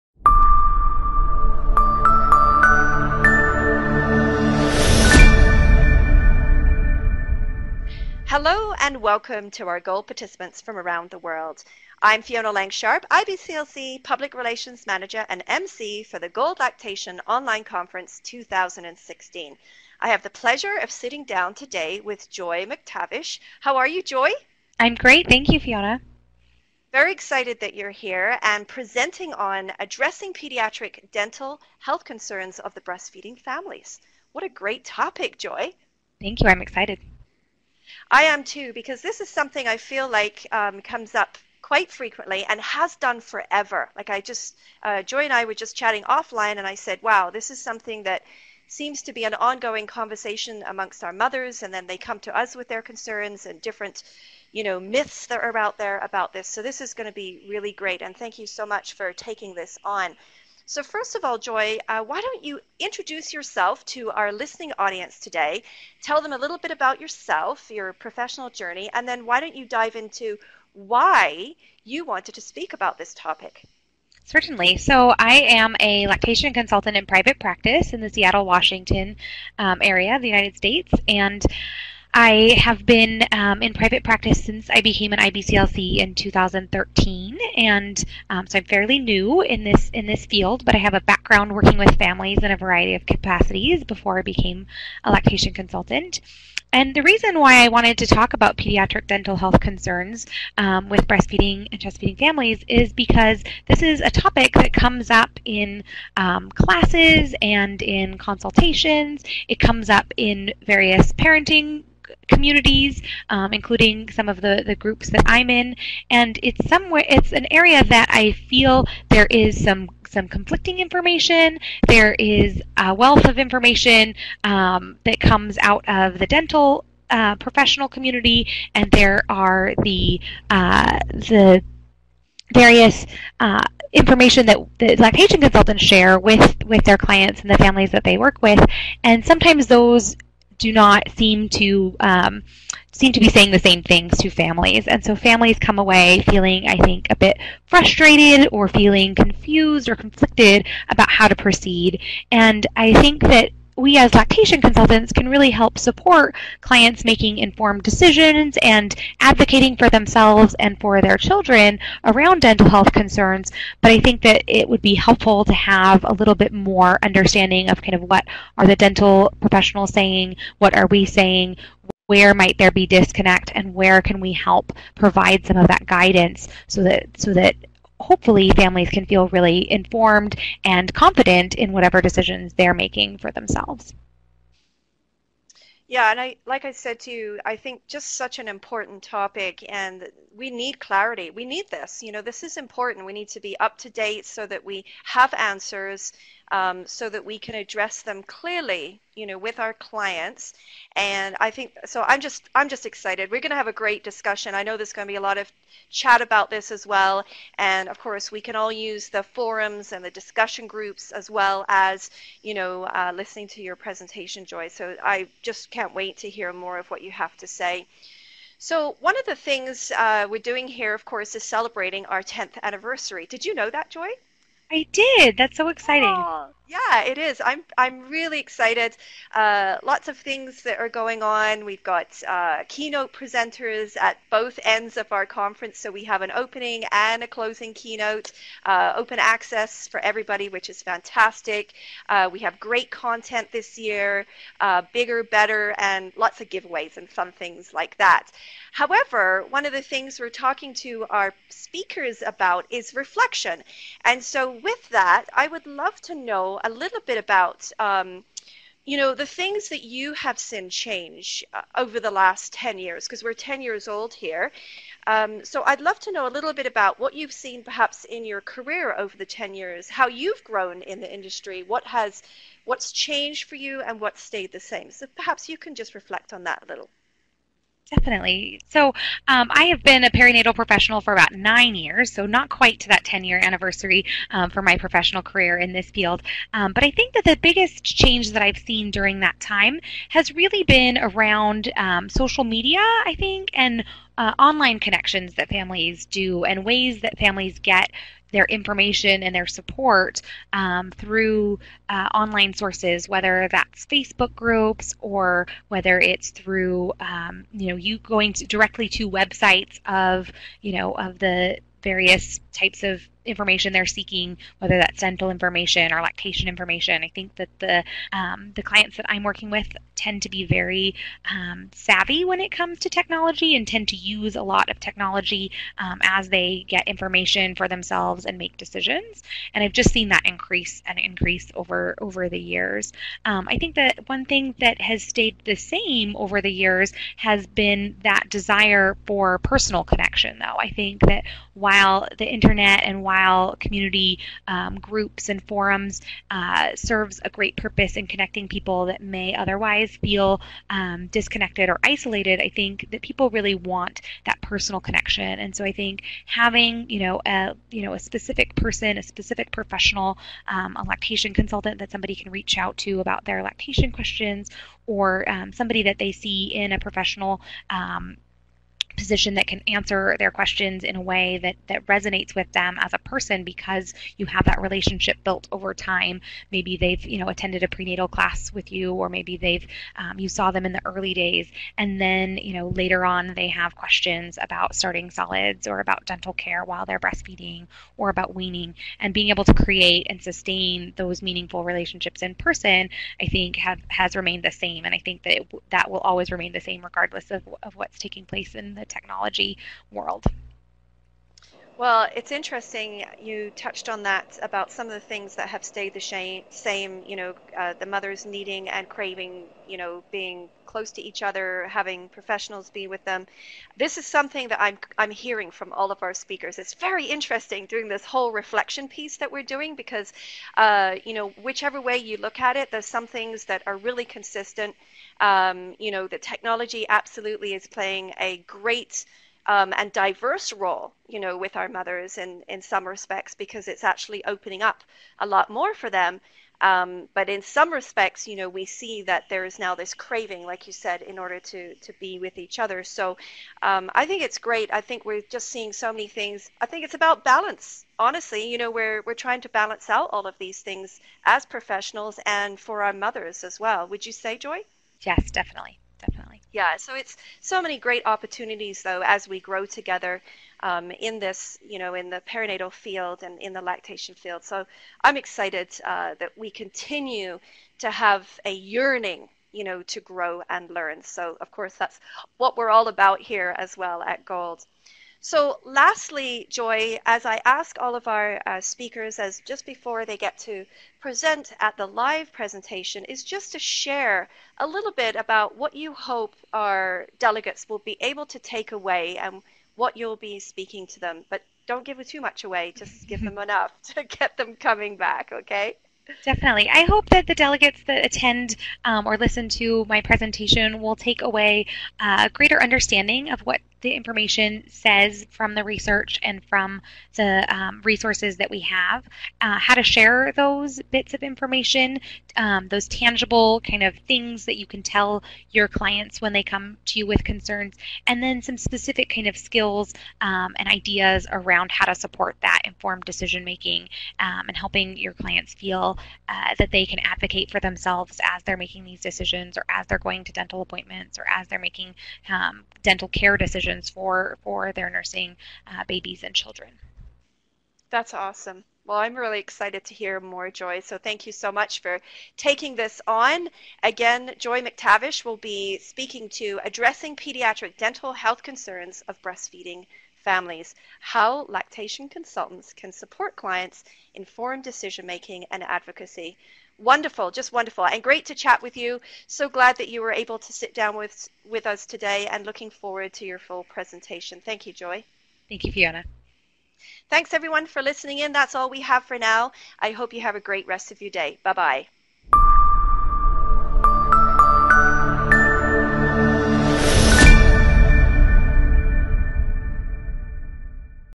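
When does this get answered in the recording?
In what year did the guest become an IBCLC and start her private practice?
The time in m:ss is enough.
1:26.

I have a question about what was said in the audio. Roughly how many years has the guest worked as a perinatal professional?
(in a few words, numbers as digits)
9.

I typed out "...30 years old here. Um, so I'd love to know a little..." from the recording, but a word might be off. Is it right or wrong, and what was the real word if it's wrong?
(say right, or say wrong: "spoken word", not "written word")
wrong: "10", not "30".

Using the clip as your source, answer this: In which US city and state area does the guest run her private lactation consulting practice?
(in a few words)
Seattle, Washington.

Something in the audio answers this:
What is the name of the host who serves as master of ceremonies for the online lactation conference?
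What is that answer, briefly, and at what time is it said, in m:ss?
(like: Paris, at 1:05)
Fiona Lang Sharp, at 0:12.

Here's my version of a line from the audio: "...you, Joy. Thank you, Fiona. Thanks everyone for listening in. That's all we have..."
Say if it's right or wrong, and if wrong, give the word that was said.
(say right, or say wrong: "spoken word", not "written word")
right.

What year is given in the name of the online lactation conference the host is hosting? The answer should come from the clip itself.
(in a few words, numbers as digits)
2016.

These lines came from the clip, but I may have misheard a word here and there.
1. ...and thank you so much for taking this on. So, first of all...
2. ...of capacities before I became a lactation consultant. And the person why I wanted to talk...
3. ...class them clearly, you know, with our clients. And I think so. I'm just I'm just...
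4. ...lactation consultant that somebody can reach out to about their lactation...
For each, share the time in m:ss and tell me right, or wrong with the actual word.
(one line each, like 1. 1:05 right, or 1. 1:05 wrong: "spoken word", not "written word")
1. 0:58 right
2. 1:32 wrong: "reason", not "person"
3. 3:17 wrong: "address", not "class"
4. 6:00 right.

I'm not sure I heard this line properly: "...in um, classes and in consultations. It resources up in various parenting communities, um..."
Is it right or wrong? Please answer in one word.
wrong.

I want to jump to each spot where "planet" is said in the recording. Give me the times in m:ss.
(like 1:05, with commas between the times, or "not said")
not said.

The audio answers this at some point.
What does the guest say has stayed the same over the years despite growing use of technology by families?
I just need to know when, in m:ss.
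5:38.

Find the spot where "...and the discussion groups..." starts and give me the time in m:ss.
3:29.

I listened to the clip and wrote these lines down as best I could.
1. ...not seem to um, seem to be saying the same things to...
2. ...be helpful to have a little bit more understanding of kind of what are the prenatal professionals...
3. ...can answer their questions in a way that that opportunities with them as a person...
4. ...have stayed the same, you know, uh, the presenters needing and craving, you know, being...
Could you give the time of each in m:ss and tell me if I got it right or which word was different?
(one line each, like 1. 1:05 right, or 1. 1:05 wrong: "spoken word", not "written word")
1. 2:20 right
2. 2:44 wrong: "dental", not "prenatal"
3. 6:09 wrong: "resonates", not "opportunities"
4. 6:45 wrong: "mothers", not "presenters".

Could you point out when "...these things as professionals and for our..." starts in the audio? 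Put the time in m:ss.
7:30.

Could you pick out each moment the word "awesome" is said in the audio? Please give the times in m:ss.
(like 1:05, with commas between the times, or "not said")
8:58.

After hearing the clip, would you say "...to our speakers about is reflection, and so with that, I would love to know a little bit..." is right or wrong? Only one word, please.
right.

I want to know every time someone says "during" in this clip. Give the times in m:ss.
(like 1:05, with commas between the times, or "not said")
4:48.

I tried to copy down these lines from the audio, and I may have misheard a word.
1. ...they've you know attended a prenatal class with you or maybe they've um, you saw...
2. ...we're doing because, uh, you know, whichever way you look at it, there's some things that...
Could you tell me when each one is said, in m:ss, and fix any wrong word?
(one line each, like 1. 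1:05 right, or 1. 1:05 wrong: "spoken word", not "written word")
1. 6:16 right
2. 6:59 right.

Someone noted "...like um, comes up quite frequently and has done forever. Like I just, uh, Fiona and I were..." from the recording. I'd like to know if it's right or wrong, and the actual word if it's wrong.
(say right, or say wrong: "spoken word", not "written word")
wrong: "Joy", not "Fiona".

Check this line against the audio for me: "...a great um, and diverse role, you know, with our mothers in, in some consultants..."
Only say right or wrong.
wrong.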